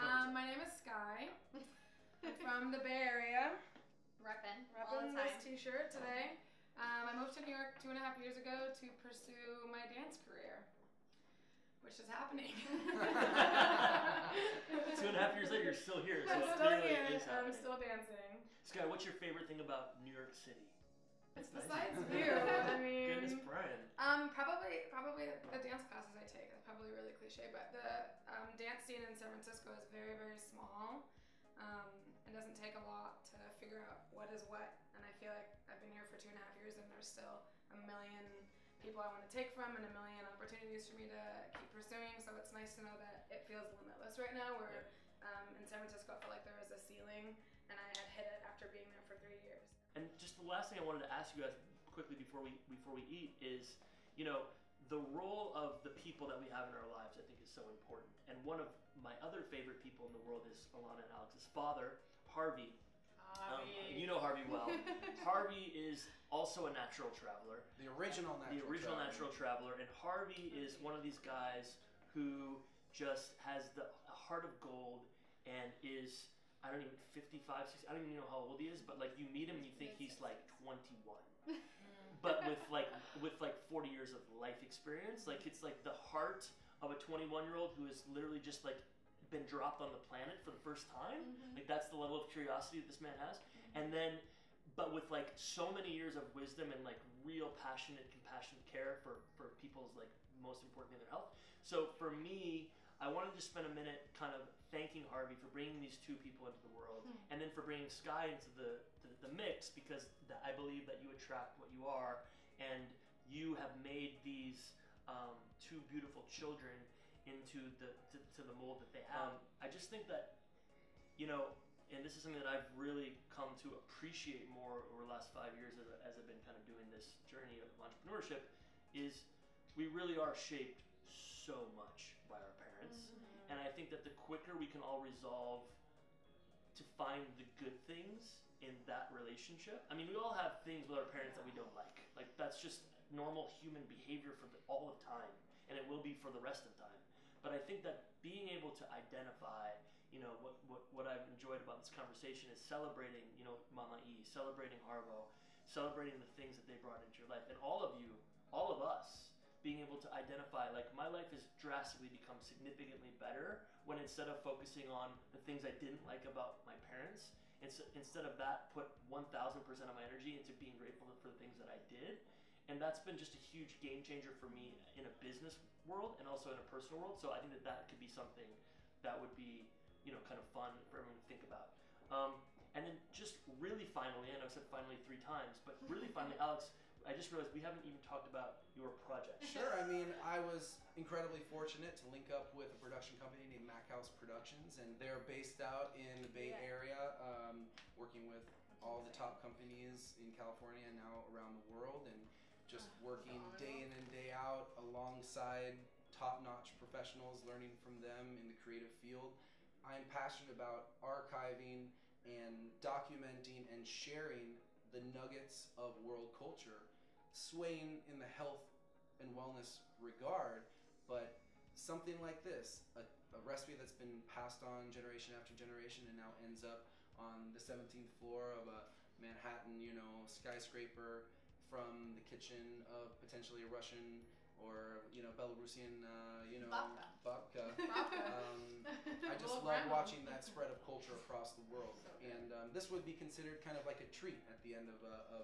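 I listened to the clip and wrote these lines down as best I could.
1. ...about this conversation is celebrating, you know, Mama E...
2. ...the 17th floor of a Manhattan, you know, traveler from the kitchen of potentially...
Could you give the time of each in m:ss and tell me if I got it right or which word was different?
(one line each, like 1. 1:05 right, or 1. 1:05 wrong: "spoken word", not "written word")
1. 2:31 right
2. 3:47 wrong: "skyscraper", not "traveler".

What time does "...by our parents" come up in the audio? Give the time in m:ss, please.
2:12.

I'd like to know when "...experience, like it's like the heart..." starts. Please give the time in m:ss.
1:24.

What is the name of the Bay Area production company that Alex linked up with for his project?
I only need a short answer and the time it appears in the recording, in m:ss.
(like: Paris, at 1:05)
Mac House Productions, at 3:13.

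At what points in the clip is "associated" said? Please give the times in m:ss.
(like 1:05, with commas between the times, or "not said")
not said.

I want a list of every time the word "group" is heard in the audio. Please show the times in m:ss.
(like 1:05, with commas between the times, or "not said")
not said.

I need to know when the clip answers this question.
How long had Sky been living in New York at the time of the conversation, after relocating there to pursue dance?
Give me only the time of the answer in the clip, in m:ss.
0:07.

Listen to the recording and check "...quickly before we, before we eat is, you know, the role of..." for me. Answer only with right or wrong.
right.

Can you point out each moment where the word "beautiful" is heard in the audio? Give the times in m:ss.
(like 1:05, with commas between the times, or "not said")
1:55.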